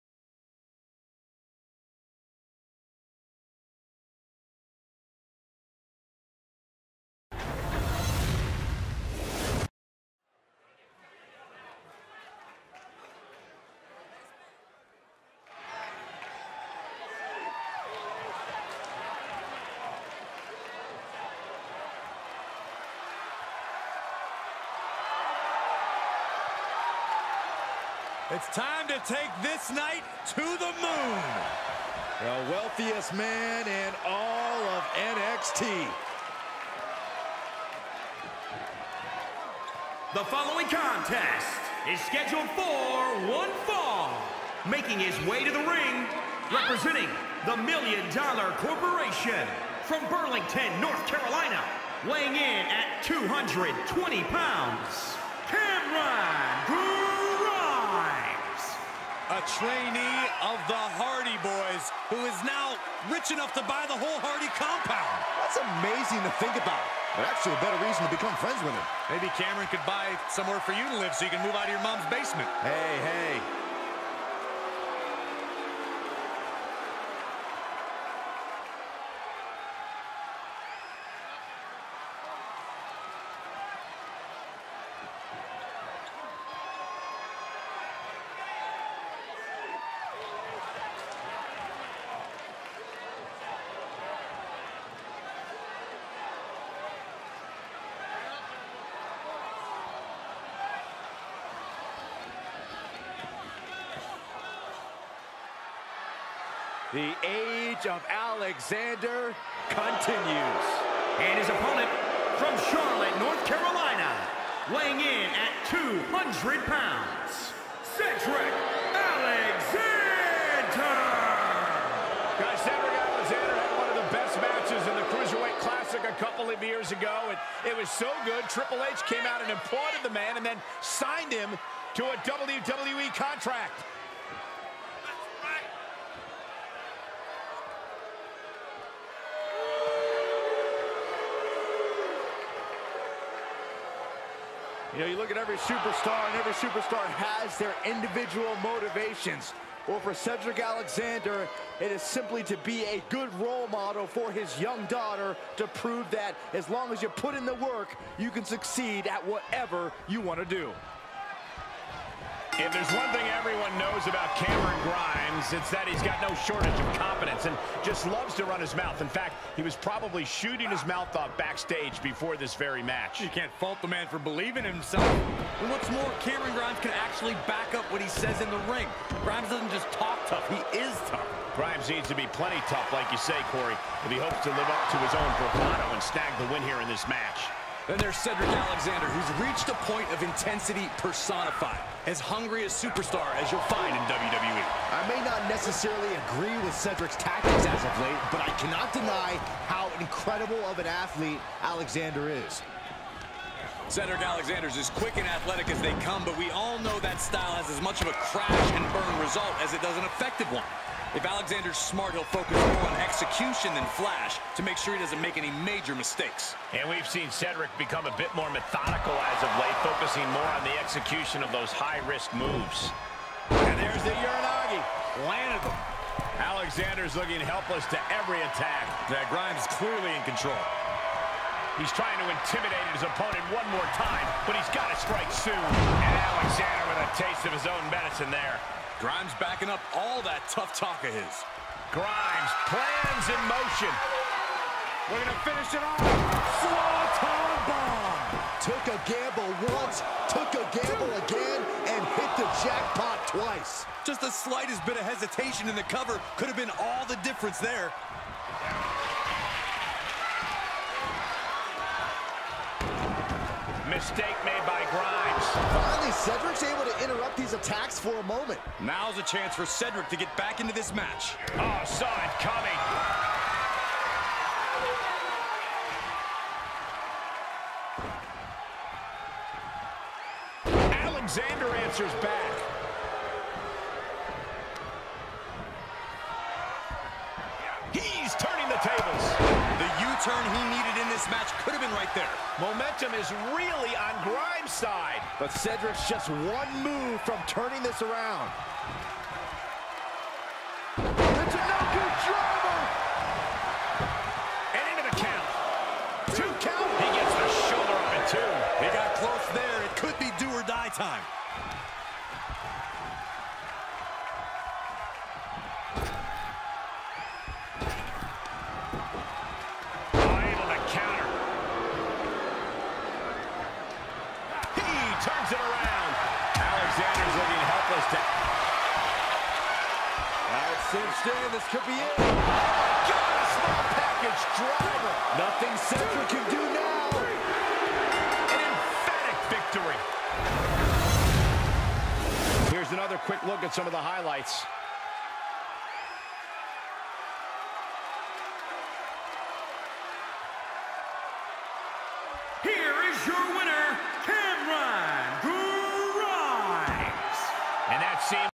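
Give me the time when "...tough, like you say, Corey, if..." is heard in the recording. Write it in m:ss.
3:02.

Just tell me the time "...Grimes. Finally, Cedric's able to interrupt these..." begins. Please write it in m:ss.
4:24.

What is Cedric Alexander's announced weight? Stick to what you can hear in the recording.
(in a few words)
200 pounds.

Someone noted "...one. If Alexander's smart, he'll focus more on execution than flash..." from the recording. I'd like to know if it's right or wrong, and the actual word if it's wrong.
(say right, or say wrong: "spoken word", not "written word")
right.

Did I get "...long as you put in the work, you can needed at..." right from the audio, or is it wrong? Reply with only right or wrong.
wrong.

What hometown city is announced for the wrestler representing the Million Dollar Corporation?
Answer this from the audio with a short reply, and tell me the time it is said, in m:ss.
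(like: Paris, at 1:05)
Burlington, North Carolina, at 0:50.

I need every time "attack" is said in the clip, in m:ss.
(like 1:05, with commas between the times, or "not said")
3:48, 4:27.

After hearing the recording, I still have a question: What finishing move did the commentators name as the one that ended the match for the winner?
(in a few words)
Small package driver.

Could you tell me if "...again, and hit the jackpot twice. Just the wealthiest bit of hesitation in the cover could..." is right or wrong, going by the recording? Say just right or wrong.
wrong.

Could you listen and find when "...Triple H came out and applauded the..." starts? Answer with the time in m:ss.
2:08.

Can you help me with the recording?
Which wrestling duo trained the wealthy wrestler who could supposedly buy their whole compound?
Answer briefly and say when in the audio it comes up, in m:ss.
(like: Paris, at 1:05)
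The Hardy Boys, at 1:01.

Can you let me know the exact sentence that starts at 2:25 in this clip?
You know, you look at every superstar, and every superstar has their individual motivations.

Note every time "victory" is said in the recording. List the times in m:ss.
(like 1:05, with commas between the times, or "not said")
5:39.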